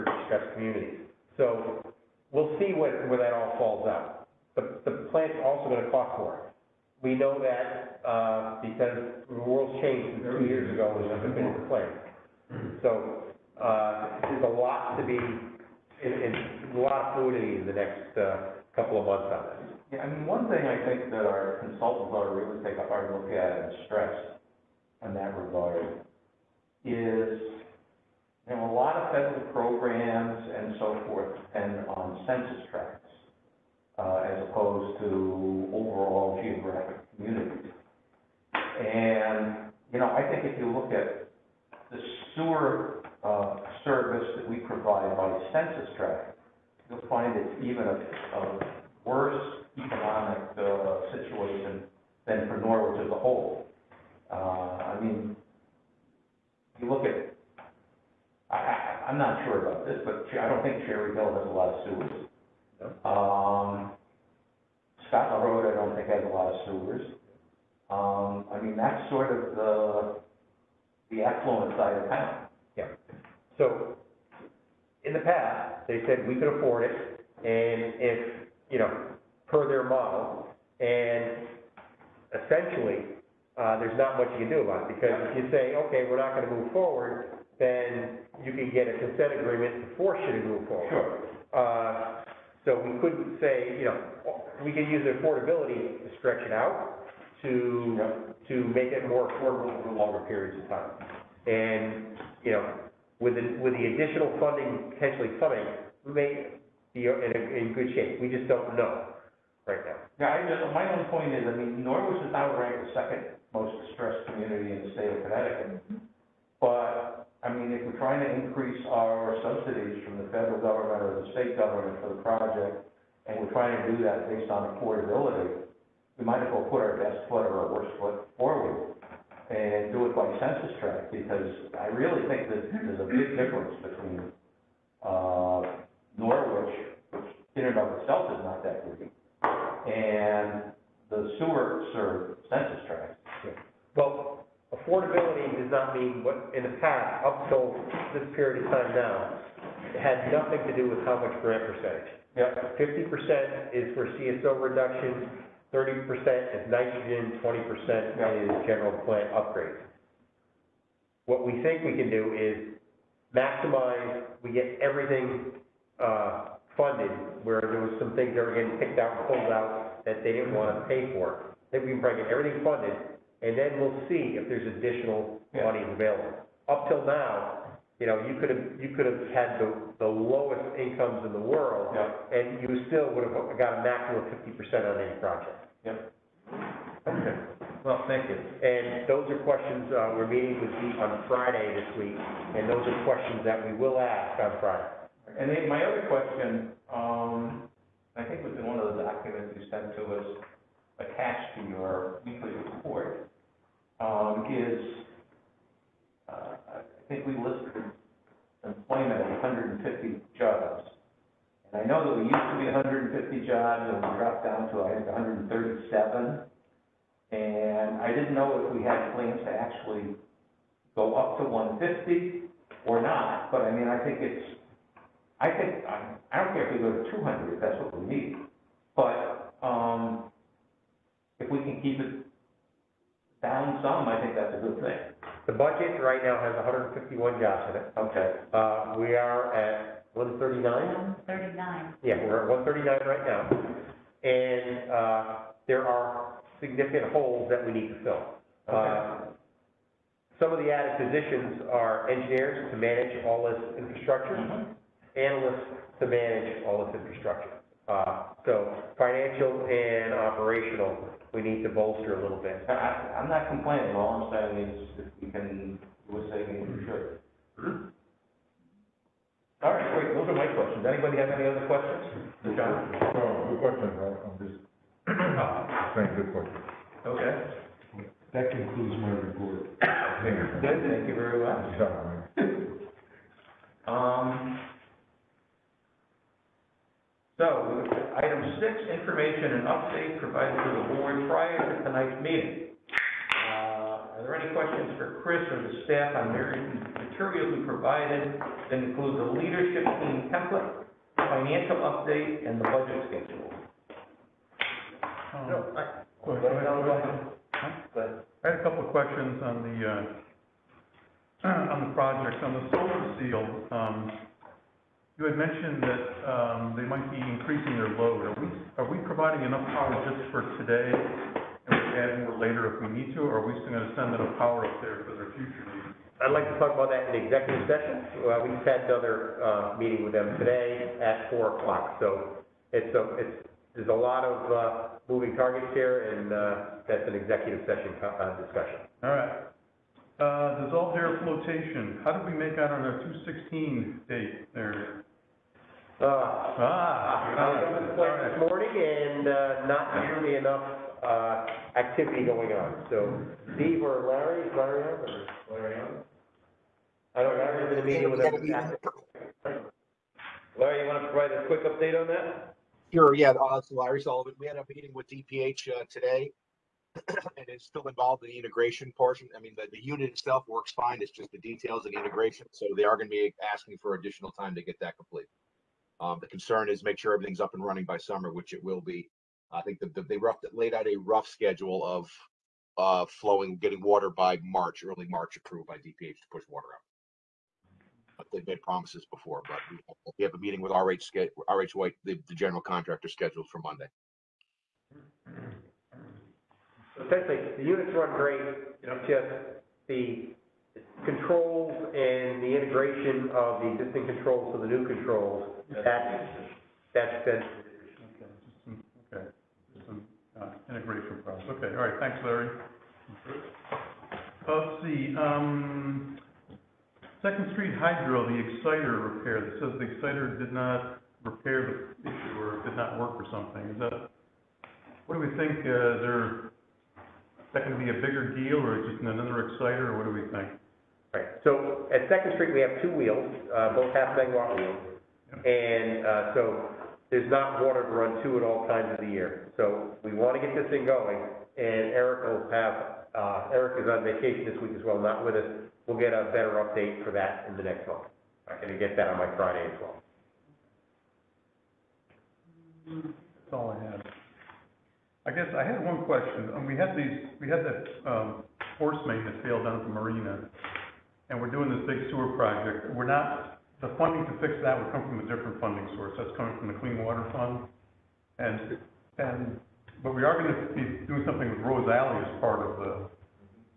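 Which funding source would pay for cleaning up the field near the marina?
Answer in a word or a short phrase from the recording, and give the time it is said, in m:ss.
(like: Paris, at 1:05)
Clean Water Fund, at 7:46.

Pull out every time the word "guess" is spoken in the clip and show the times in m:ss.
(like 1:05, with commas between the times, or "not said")
7:35.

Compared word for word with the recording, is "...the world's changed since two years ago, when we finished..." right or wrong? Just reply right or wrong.
right.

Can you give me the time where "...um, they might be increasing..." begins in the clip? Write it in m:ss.
5:16.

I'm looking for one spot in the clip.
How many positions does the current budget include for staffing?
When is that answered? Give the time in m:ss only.
3:56.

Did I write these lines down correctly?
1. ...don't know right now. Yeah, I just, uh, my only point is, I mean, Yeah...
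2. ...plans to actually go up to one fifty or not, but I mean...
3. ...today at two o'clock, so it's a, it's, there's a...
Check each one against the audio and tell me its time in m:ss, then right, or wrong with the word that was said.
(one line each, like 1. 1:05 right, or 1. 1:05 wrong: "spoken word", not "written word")
1. 1:48 wrong: "Norwich", not "Yeah"
2. 3:39 right
3. 5:30 wrong: "four", not "two".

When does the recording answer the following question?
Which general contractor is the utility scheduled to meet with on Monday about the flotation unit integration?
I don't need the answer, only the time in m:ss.
6:31.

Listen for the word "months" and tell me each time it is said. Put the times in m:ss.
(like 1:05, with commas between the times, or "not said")
0:19, 7:27.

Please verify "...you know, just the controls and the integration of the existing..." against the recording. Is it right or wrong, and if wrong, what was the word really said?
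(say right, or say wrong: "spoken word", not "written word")
right.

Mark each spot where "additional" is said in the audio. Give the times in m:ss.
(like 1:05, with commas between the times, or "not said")
1:43, 2:54, 6:13.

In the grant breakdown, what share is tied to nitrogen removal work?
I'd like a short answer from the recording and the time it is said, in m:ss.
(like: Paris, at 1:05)
30%, at 2:35.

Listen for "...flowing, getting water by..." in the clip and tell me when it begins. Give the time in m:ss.
6:23.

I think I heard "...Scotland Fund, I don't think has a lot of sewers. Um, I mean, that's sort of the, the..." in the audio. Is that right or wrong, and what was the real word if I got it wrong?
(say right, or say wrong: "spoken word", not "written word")
wrong: "Road", not "Fund".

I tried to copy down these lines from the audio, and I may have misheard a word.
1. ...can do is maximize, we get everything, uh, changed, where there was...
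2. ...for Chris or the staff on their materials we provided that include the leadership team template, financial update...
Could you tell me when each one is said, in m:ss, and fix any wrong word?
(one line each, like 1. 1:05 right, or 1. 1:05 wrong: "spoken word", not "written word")
1. 2:41 wrong: "funded", not "changed"
2. 4:55 right.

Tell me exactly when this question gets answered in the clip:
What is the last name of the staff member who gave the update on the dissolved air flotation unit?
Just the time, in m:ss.
6:04.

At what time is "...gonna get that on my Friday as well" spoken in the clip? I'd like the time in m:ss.
7:28.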